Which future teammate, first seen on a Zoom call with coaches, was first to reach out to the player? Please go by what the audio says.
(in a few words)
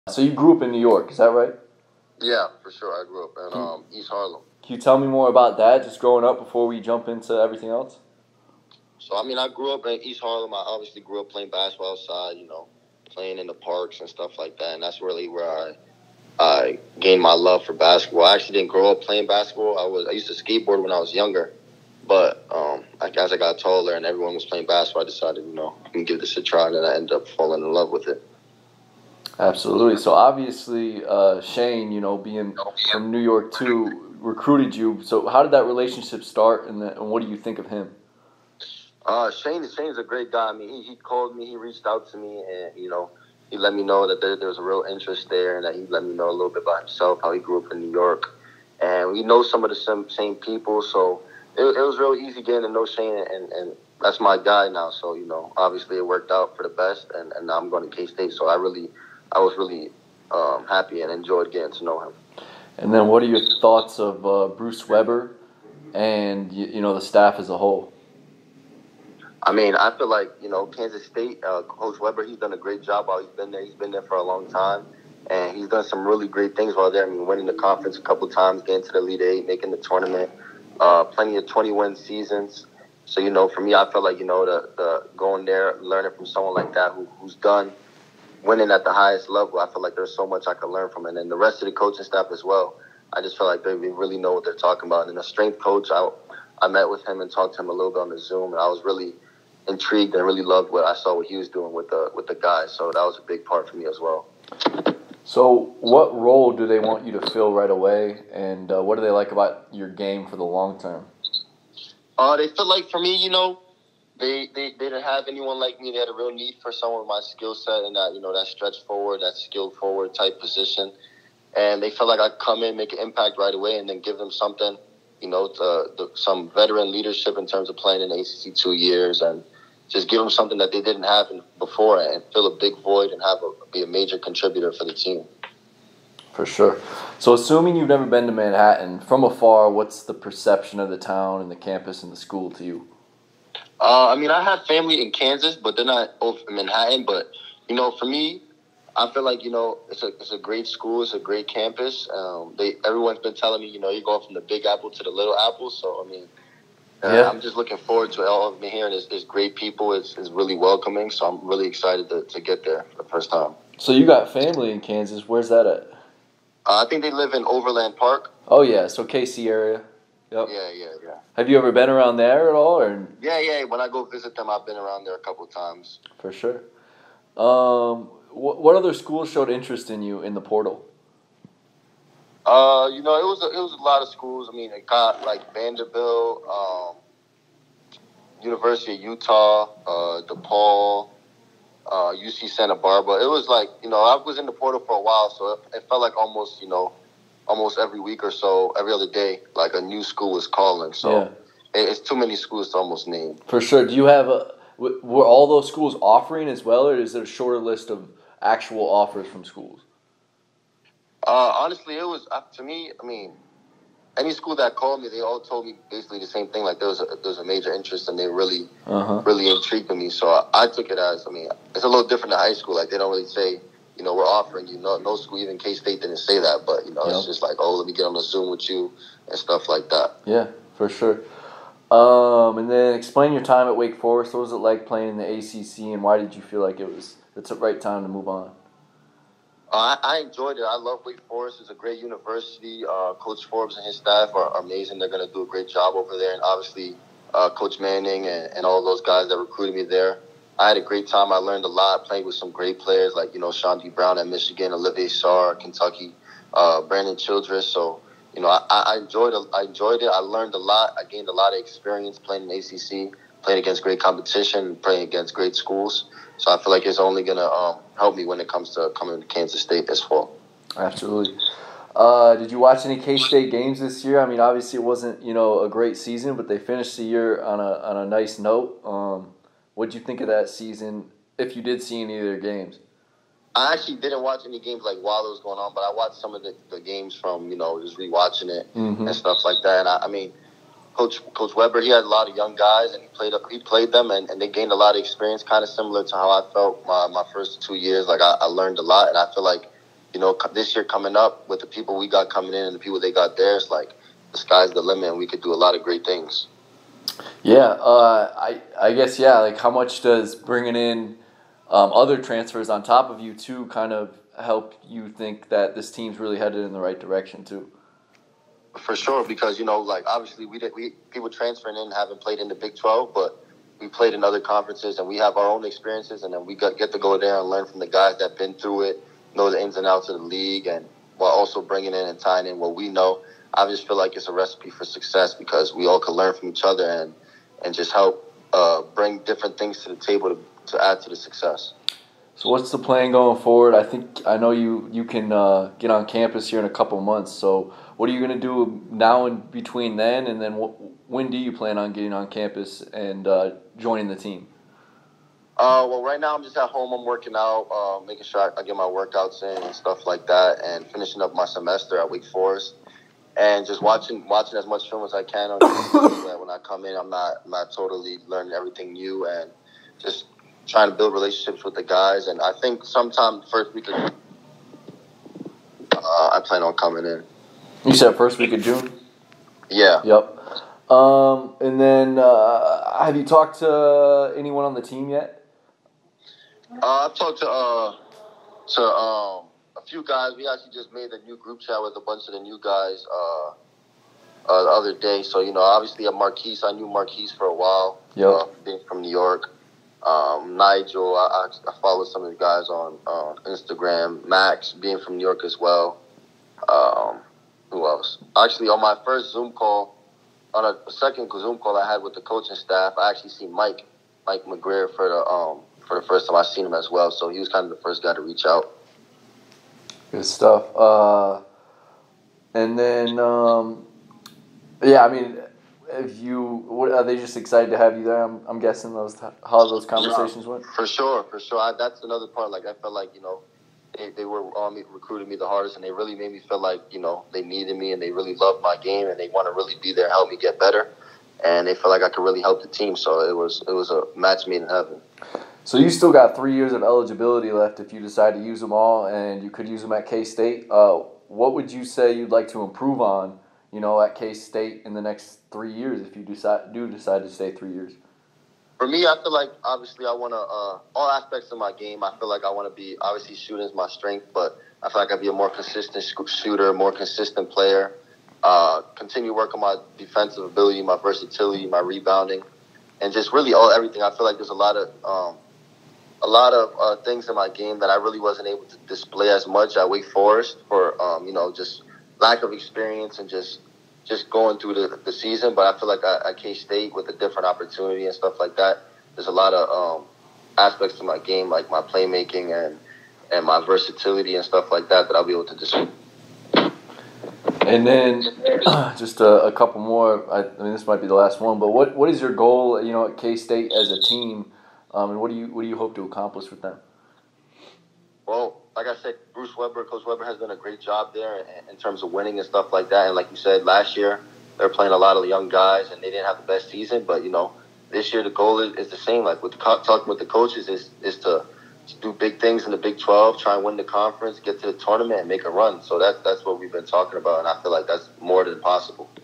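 Mike McGuirl.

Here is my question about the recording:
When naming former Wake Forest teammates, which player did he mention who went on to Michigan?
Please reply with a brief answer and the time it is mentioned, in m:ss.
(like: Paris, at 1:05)
Chaundee Brown, at 4:13.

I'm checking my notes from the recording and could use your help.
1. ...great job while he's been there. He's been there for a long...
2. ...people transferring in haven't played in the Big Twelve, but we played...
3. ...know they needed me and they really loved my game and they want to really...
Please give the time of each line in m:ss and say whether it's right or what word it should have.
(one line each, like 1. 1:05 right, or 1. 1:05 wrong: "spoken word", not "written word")
1. 1:12 right
2. 5:21 right
3. 7:16 right.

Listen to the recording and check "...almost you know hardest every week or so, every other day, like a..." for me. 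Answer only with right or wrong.
wrong.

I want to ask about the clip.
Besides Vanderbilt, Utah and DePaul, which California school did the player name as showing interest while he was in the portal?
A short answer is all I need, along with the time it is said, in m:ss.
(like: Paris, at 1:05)
UC Santa Barbara, at 3:12.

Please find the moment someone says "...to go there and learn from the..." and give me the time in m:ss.
5:26.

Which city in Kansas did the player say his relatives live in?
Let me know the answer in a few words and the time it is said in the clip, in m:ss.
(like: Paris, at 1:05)
Overland Park, at 2:47.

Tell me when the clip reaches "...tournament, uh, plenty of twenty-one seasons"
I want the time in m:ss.
1:19.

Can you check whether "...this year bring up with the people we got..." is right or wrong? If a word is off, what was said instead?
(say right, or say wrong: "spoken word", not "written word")
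wrong: "coming", not "bring".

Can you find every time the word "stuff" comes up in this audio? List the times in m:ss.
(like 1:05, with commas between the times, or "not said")
0:14, 3:49, 4:49, 5:59, 7:00, 8:08, 8:14, 8:32.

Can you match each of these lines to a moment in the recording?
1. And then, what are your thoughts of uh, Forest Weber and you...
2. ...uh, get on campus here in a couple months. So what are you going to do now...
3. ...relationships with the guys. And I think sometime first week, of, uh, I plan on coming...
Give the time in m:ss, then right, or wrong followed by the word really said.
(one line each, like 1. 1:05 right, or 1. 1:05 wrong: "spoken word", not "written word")
1. 1:02 wrong: "Bruce", not "Forest"
2. 5:45 right
3. 6:11 right.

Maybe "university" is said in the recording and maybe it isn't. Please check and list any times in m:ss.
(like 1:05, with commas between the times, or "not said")
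3:08, 4:01.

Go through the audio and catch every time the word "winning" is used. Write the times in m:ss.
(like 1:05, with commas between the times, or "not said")
1:17, 1:28, 8:32.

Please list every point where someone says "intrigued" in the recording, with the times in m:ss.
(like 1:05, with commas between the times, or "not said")
1:39, 3:39.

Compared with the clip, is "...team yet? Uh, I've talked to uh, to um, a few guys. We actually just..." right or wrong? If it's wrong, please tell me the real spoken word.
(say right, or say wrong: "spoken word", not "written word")
right.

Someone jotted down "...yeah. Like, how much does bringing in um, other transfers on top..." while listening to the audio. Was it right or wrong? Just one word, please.
right.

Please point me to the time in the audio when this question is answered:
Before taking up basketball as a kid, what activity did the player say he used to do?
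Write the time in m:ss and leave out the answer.
0:20.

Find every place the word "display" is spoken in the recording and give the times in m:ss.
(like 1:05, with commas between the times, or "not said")
7:58, 8:15.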